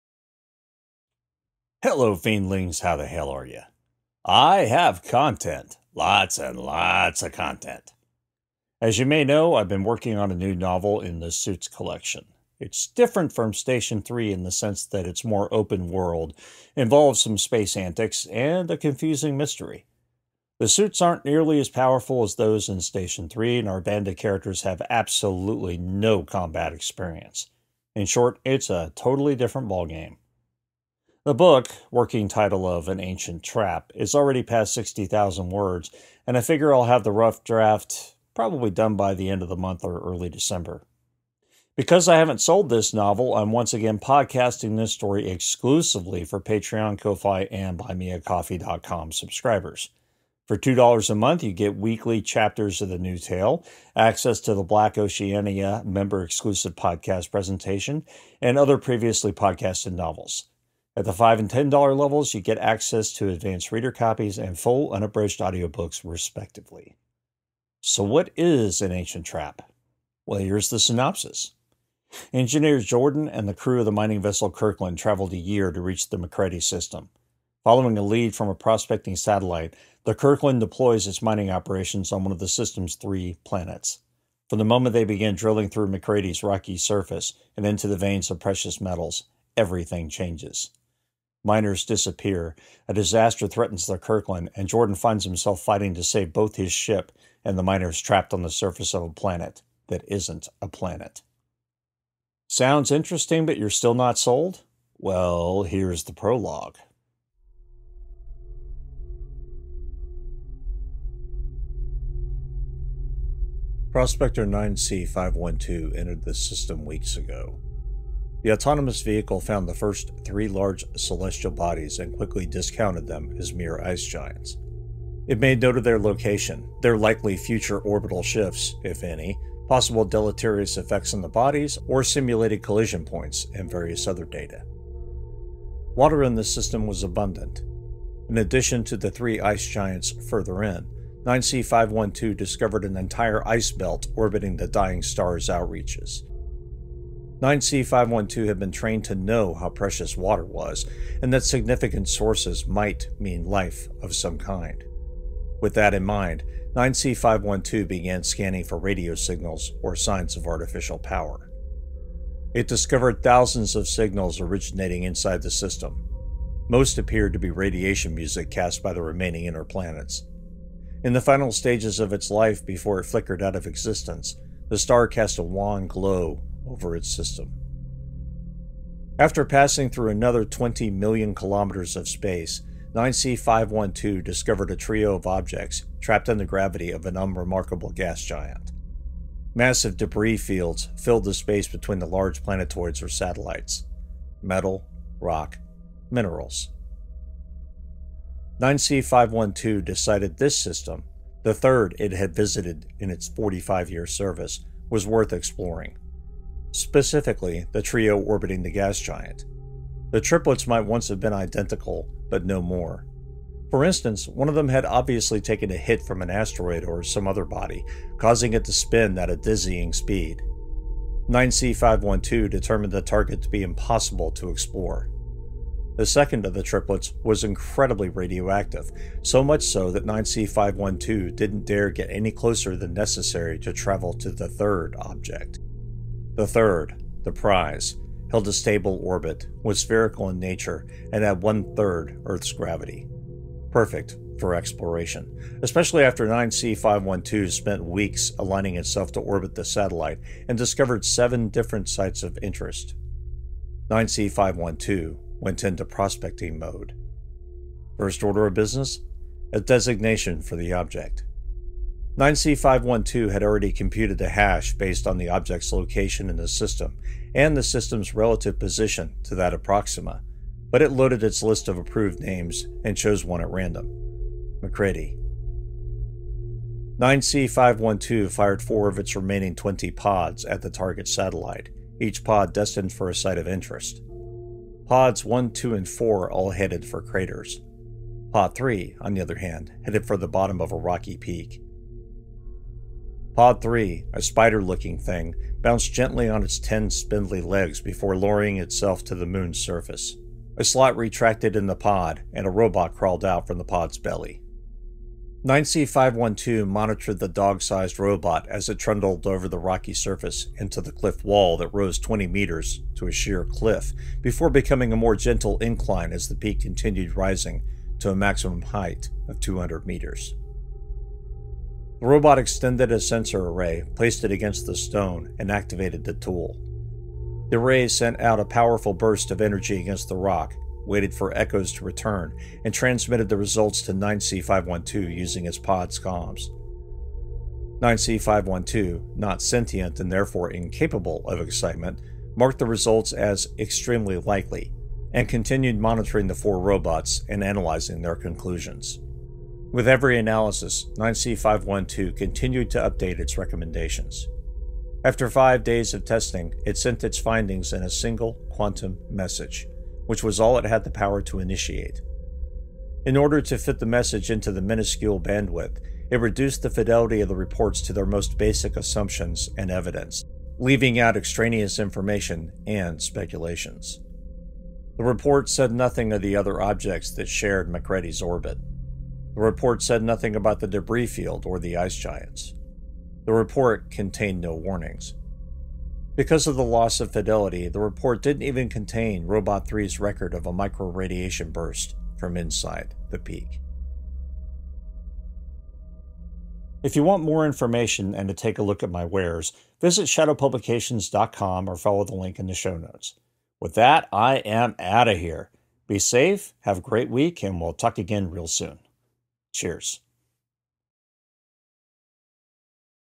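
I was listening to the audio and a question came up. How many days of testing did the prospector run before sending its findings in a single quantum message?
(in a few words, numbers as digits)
5.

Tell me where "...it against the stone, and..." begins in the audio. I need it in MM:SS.
05:24.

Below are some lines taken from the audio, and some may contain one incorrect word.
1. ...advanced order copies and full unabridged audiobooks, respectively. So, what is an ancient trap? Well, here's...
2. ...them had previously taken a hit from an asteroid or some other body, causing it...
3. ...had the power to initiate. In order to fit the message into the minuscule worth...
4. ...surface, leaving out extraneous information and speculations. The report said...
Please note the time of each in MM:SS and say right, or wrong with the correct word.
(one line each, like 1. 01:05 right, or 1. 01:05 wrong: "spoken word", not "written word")
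1. 01:03 wrong: "reader", not "order"
2. 03:34 wrong: "obviously", not "previously"
3. 06:00 wrong: "bandwidth", not "worth"
4. 06:09 wrong: "evidence", not "surface".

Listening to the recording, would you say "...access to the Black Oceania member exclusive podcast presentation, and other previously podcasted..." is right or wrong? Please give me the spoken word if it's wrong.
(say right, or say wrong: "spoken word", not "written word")
right.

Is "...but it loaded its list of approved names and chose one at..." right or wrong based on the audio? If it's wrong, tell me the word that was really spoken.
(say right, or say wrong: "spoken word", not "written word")
right.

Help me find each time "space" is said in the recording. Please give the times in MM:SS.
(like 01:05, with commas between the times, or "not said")
00:17, 03:02, 03:11.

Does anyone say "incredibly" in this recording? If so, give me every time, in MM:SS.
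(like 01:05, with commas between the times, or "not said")
03:47.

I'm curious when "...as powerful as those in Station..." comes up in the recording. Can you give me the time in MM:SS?
00:21.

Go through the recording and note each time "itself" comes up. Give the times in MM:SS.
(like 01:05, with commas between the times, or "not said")
04:08, 04:58.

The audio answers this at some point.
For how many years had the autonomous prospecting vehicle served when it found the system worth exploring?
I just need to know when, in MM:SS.
03:23.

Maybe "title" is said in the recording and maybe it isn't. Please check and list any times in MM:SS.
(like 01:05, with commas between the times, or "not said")
00:32.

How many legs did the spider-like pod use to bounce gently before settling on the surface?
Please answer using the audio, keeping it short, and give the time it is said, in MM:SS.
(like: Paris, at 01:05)
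10, at 04:56.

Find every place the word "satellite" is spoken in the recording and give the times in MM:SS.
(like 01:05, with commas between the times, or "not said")
01:19, 03:13, 04:09, 04:41.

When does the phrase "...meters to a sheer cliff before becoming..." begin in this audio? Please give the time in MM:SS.
05:12.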